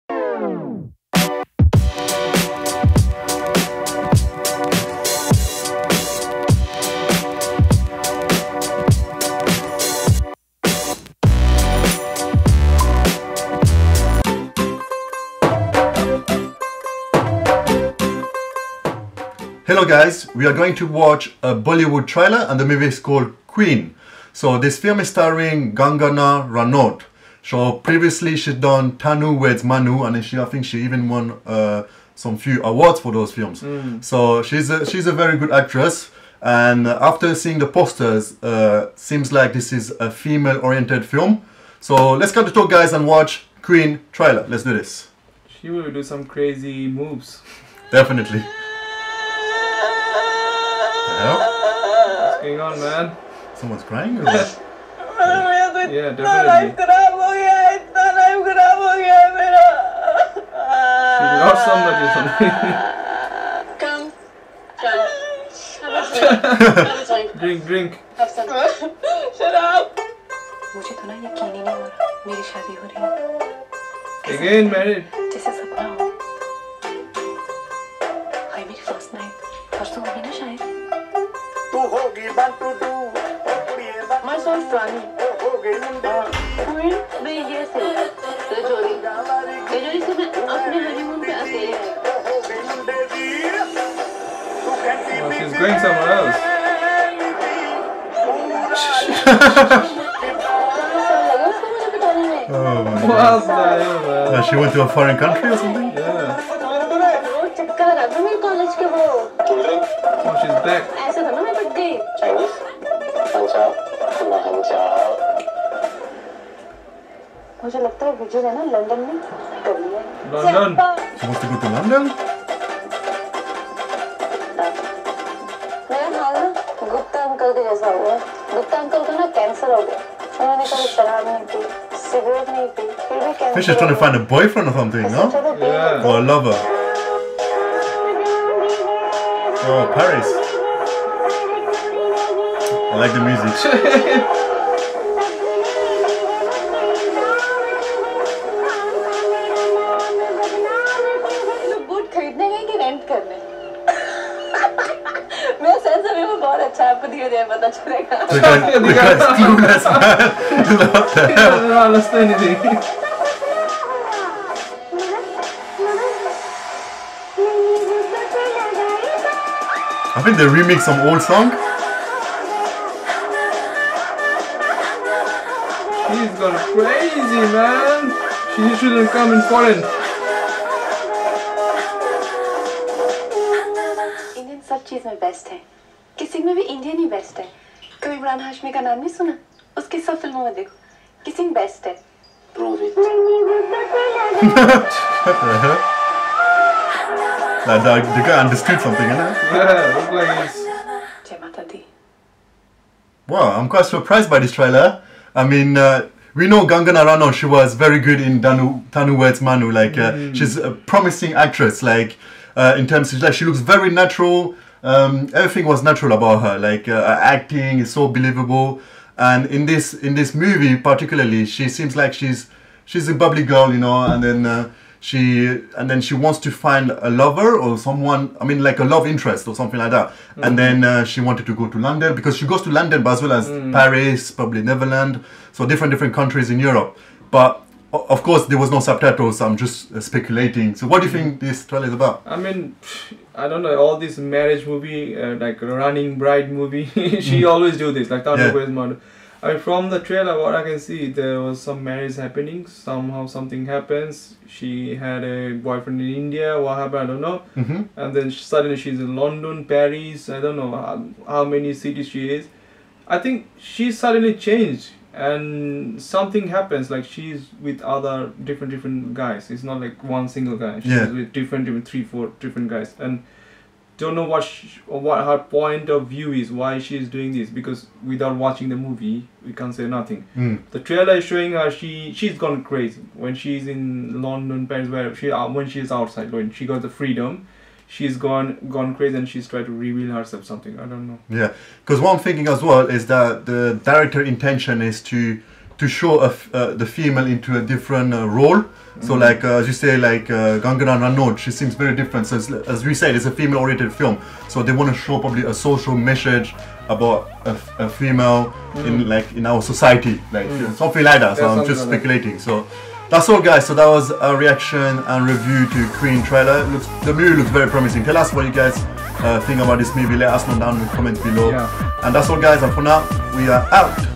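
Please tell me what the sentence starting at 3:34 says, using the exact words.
Um, everything was natural about her.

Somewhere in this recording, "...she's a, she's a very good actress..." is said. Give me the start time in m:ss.
0:34.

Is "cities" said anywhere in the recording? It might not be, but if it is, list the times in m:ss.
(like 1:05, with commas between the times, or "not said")
4:21.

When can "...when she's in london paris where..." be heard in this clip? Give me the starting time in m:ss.
4:43.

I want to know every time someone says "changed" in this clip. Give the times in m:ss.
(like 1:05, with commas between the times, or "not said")
4:24.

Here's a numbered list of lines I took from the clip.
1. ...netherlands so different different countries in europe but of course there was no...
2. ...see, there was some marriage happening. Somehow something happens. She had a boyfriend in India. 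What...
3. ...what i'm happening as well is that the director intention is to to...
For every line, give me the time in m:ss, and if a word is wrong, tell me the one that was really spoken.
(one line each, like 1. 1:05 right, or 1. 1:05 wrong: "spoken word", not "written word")
1. 3:54 right
2. 4:10 right
3. 4:52 wrong: "thinking", not "happening".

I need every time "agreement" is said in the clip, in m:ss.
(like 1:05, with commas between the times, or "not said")
not said.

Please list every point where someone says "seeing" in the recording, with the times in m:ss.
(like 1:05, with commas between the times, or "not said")
0:37.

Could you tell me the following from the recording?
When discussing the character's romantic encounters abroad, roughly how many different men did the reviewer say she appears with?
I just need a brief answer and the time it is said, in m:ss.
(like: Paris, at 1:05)
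3 or 4, at 4:31.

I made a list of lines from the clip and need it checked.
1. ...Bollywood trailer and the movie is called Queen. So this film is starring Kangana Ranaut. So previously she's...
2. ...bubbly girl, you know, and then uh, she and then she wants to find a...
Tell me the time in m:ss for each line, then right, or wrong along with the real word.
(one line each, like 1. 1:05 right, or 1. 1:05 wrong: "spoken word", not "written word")
1. 0:21 right
2. 3:43 right.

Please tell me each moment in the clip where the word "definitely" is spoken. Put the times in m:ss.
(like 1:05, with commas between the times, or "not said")
0:47, 0:56.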